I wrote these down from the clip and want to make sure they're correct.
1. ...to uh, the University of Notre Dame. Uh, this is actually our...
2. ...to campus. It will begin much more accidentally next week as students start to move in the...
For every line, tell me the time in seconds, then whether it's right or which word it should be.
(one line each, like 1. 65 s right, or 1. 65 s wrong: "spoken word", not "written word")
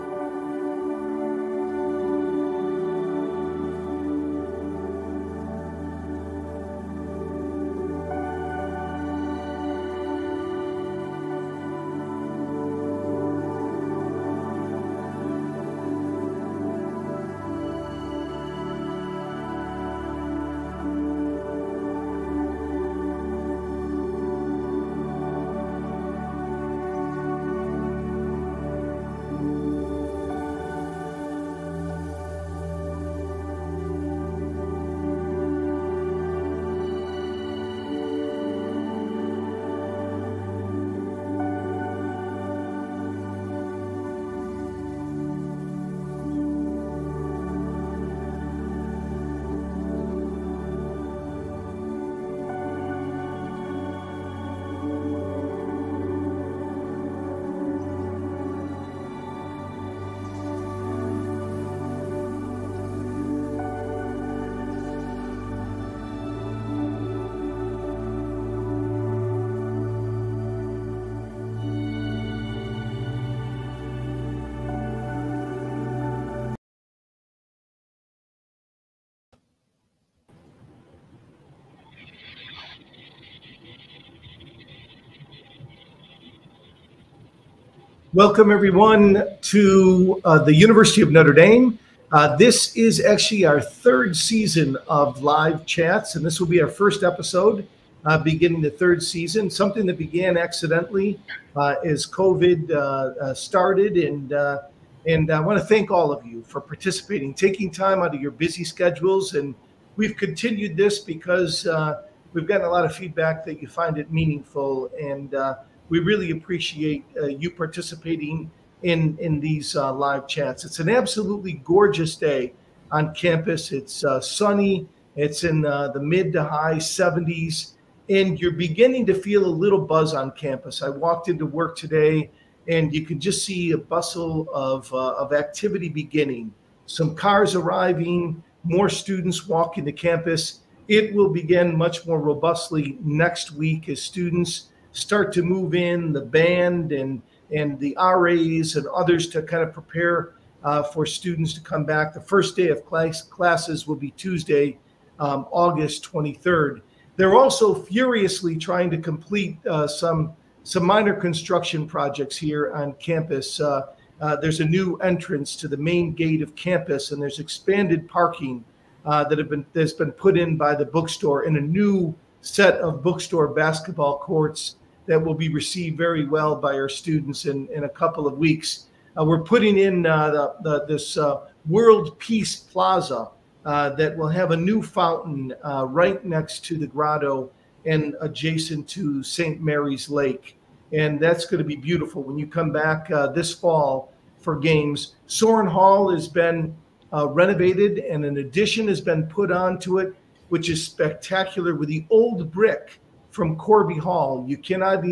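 1. 89 s right
2. 139 s wrong: "robustly", not "accidentally".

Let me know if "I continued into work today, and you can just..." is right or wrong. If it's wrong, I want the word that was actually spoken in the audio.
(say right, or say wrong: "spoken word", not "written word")
wrong: "walked", not "continued".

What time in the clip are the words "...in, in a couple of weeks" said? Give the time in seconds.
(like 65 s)
177 s.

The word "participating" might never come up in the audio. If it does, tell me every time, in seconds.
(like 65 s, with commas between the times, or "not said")
106 s, 117 s.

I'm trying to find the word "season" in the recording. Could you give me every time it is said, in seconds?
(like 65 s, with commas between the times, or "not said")
94 s, 99 s.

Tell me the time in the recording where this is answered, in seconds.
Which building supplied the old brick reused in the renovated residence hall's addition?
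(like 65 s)
203 s.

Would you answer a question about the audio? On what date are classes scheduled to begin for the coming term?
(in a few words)
August 23rd.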